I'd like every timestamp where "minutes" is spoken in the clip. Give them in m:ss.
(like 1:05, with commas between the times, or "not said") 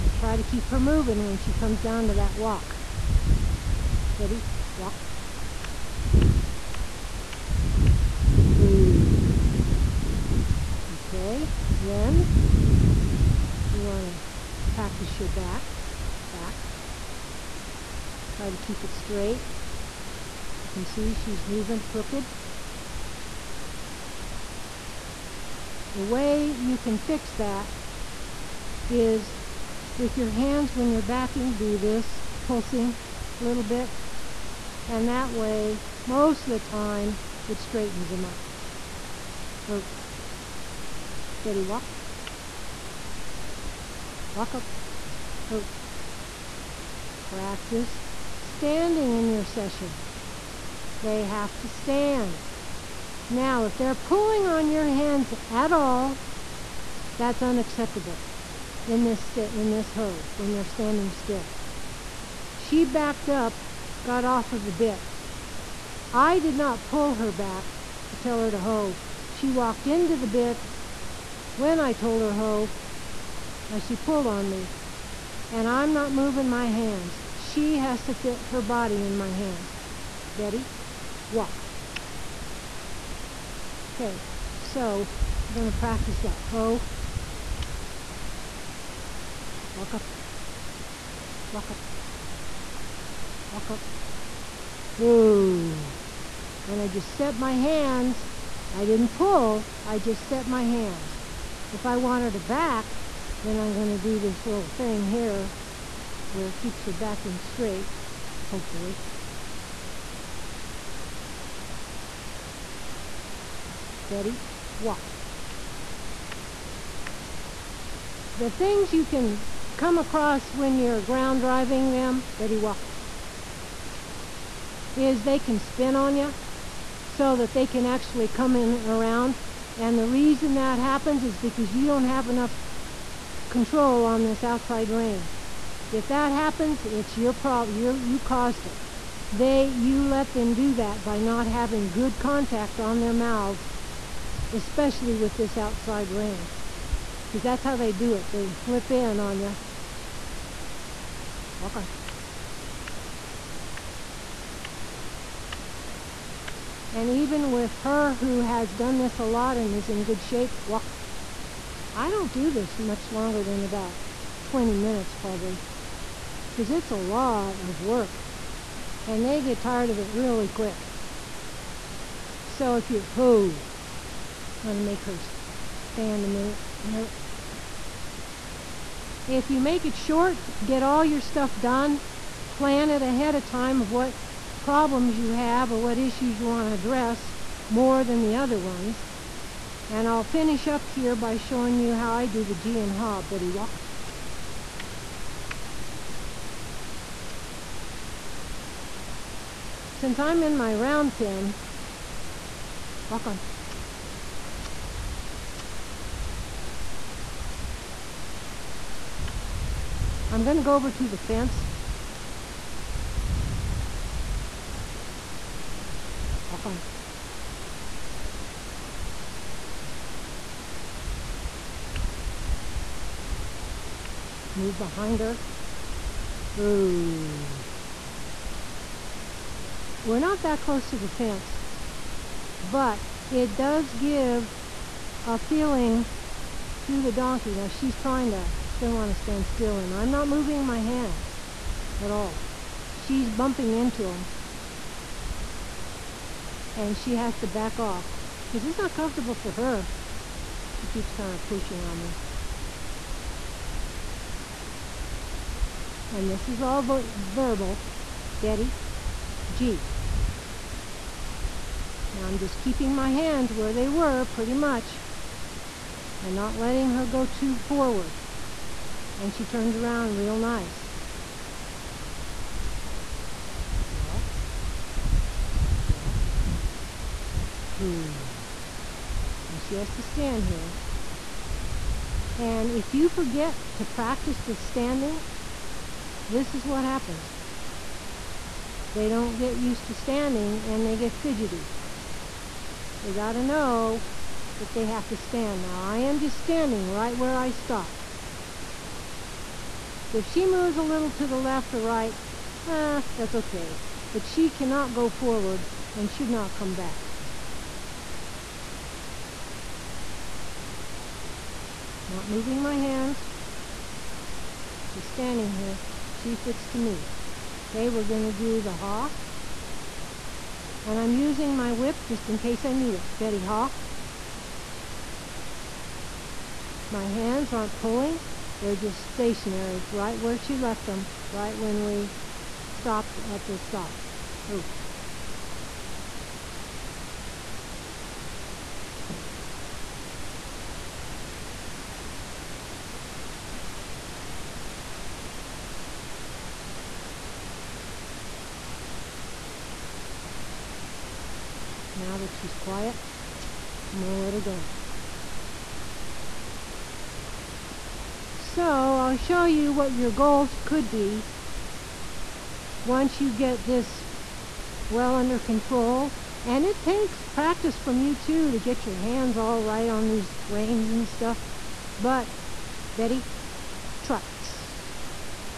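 2:44, 2:56.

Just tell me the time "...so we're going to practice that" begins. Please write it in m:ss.
1:24.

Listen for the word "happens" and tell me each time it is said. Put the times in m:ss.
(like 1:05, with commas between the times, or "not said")
2:10, 2:16, 4:46.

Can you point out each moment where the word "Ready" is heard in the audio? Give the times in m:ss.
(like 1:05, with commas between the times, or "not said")
0:04.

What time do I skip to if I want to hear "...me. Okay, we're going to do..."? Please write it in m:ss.
5:16.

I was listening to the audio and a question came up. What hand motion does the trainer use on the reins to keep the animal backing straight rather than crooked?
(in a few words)
pulsing.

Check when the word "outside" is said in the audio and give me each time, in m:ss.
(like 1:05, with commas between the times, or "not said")
2:14, 2:25.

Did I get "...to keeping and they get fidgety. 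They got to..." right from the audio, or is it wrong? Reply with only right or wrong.
wrong.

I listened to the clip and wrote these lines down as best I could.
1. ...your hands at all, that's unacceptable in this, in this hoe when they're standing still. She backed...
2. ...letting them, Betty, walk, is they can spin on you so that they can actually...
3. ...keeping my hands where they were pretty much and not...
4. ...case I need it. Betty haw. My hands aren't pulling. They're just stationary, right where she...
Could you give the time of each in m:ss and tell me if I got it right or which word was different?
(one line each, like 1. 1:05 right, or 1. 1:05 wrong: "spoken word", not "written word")
1. 0:54 right
2. 2:01 wrong: "driving", not "letting"
3. 4:22 right
4. 5:22 right.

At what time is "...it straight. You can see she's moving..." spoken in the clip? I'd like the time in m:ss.
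0:18.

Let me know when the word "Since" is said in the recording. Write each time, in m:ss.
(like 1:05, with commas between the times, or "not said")
3:19.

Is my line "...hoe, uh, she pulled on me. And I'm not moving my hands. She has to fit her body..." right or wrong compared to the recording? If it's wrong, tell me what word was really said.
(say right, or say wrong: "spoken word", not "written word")
right.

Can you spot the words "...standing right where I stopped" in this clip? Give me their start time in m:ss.
4:56.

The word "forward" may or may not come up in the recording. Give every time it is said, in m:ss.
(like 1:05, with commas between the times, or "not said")
4:27, 5:05.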